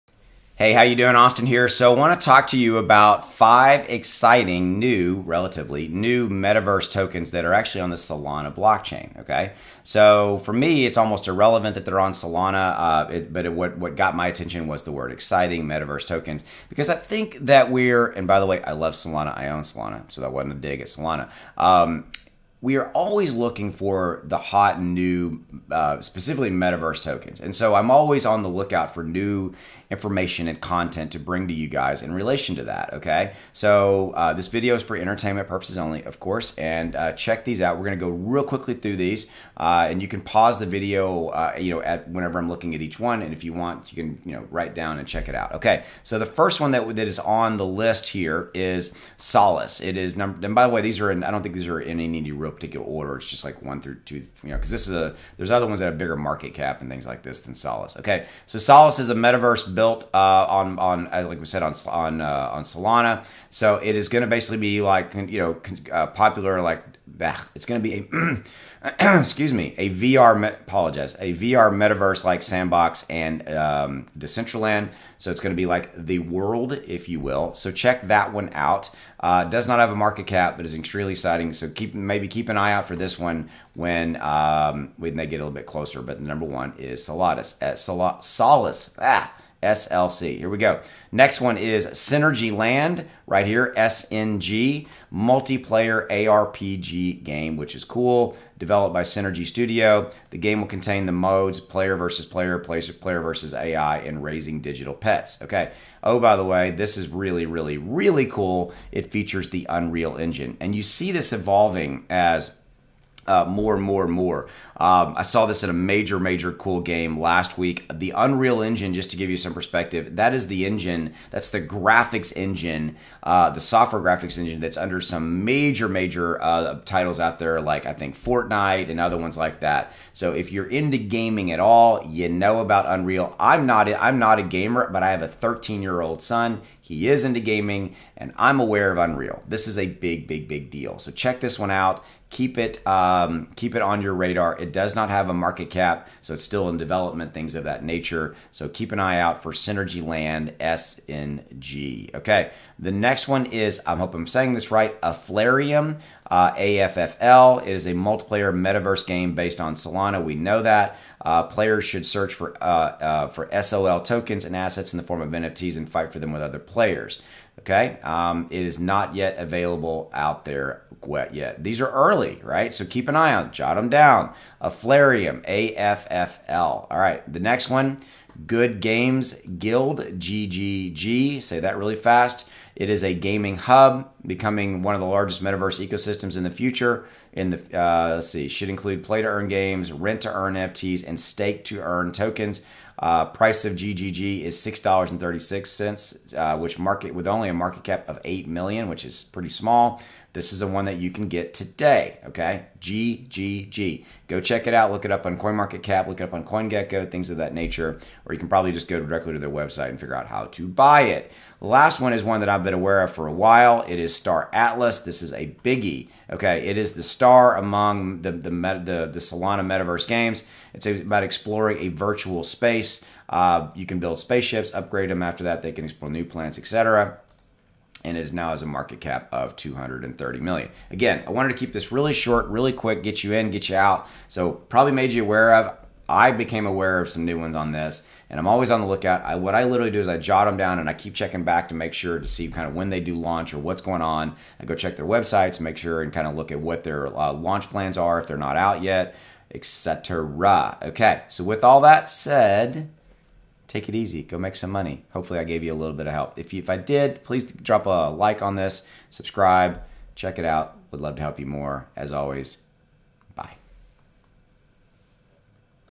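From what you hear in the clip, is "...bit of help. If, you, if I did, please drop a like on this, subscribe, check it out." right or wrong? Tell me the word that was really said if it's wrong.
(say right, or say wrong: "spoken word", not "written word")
right.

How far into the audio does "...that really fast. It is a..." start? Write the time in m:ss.
3:01.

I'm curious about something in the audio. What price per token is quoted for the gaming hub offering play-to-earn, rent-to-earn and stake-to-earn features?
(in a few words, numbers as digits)
$6.36.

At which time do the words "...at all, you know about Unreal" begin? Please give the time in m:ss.
2:11.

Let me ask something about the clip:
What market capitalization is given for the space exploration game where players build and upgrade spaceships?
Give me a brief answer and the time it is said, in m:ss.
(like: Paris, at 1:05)
230 million, at 3:49.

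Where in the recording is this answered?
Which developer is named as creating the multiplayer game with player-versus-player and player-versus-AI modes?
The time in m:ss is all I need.
1:39.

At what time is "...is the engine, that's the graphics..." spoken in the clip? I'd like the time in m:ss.
2:00.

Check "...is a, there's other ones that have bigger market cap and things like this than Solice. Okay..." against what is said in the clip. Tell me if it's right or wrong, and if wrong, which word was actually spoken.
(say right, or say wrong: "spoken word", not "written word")
right.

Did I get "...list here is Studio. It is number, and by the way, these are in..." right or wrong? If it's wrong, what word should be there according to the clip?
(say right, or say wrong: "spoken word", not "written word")
wrong: "Solice", not "Studio".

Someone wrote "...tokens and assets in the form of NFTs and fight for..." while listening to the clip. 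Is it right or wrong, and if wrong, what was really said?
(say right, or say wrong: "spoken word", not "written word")
right.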